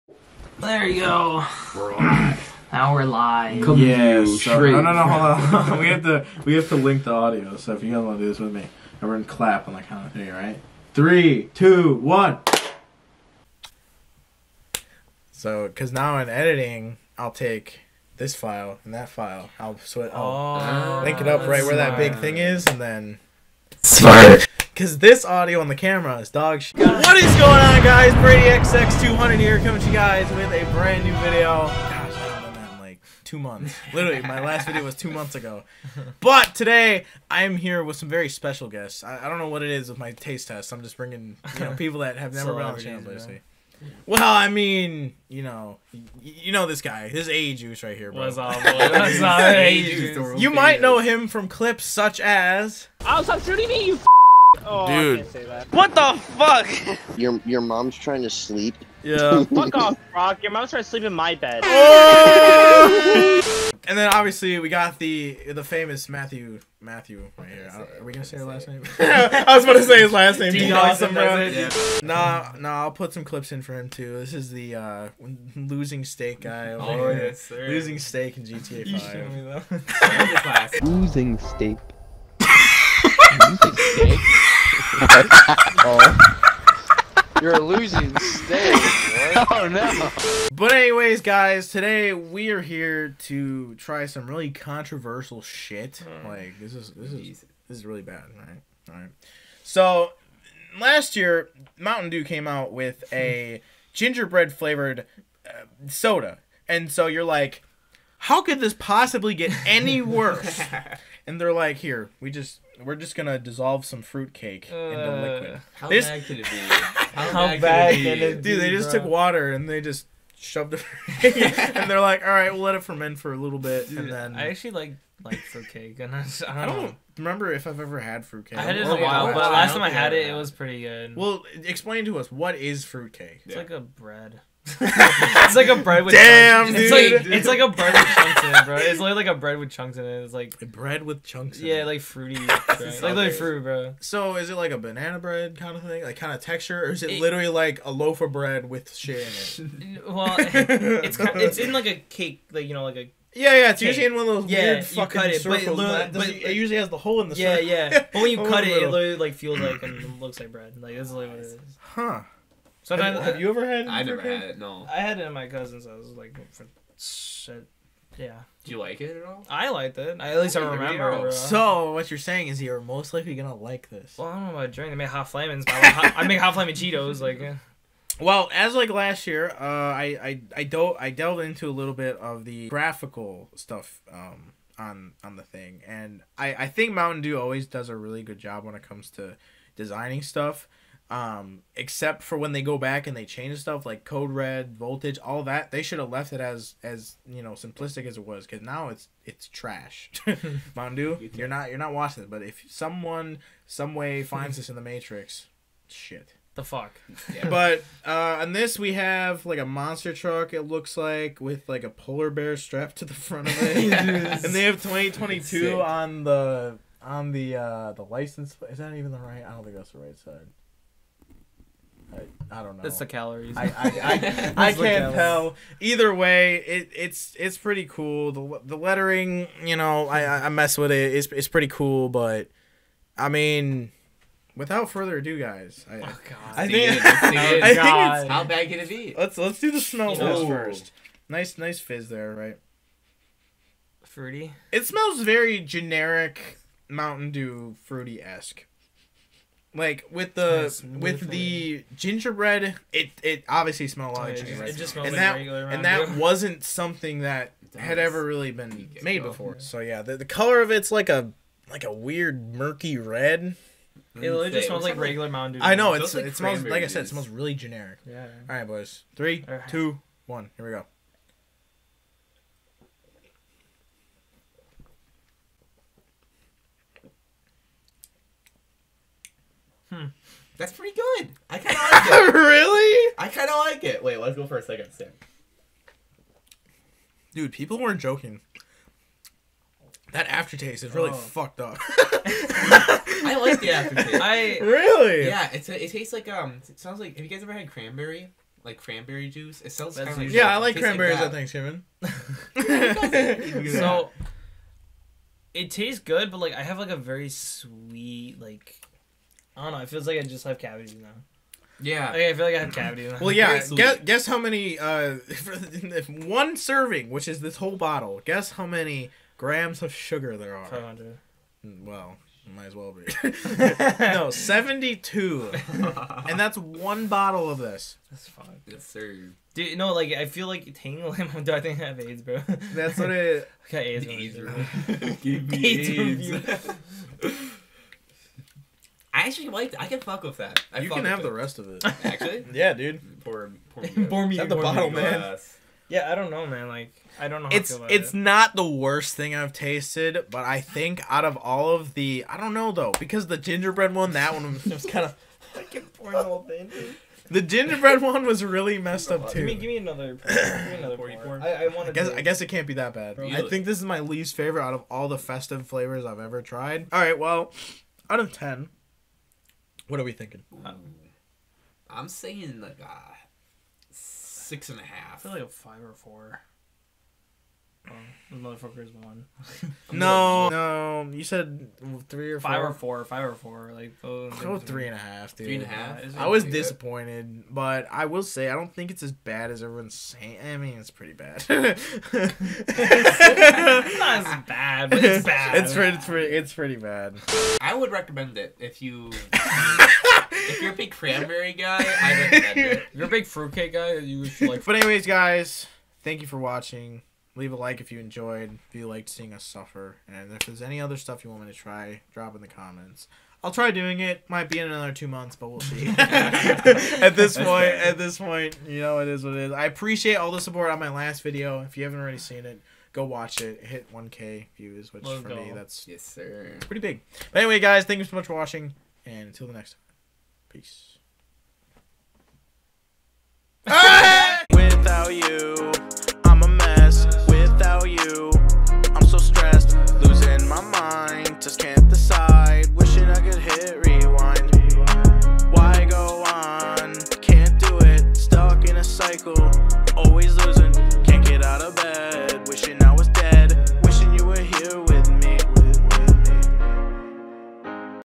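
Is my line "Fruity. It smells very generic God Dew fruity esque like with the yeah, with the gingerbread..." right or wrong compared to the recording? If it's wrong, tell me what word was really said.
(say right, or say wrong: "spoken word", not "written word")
wrong: "Mountain", not "God".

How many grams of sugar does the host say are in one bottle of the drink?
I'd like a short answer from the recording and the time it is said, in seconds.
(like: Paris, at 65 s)
72, at 324 s.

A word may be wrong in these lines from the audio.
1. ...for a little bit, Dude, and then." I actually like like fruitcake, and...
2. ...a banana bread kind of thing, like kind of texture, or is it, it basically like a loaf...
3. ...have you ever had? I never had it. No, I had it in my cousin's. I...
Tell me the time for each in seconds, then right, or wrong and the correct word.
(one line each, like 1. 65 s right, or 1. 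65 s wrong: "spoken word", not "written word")
1. 123 s right
2. 144 s wrong: "literally", not "basically"
3. 163 s right.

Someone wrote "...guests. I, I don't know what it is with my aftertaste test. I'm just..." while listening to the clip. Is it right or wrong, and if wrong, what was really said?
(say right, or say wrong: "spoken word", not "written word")
wrong: "taste", not "aftertaste".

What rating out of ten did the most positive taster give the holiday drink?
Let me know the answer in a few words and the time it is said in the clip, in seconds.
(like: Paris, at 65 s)
6.5, at 373 s.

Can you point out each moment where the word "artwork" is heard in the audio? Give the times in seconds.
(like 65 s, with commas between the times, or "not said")
not said.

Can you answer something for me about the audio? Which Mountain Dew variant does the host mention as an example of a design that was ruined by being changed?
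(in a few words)
Code Red.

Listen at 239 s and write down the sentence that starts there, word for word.
Let's let's do the smell test first.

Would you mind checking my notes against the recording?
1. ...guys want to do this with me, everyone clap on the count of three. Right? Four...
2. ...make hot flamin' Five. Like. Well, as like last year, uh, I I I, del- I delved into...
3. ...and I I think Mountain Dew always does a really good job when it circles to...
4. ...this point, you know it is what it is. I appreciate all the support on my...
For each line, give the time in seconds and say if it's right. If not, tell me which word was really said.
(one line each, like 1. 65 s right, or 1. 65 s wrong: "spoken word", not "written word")
1. 7 s wrong: "Three", not "Four"
2. 176 s wrong: "Cheetos", not "Five"
3. 185 s wrong: "comes", not "circles"
4. 417 s right.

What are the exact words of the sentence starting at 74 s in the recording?
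This is the uh, losing stake guy.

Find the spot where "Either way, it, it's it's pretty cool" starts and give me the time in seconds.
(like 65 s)
225 s.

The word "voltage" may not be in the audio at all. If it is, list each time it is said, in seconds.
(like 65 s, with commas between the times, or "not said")
194 s.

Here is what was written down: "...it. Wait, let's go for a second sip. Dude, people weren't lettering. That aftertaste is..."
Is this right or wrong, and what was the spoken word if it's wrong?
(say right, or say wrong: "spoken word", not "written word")
wrong: "joking", not "lettering".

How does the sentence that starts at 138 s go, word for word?
It's like like a bread with chunks in it.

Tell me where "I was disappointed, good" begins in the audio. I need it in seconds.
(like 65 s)
386 s.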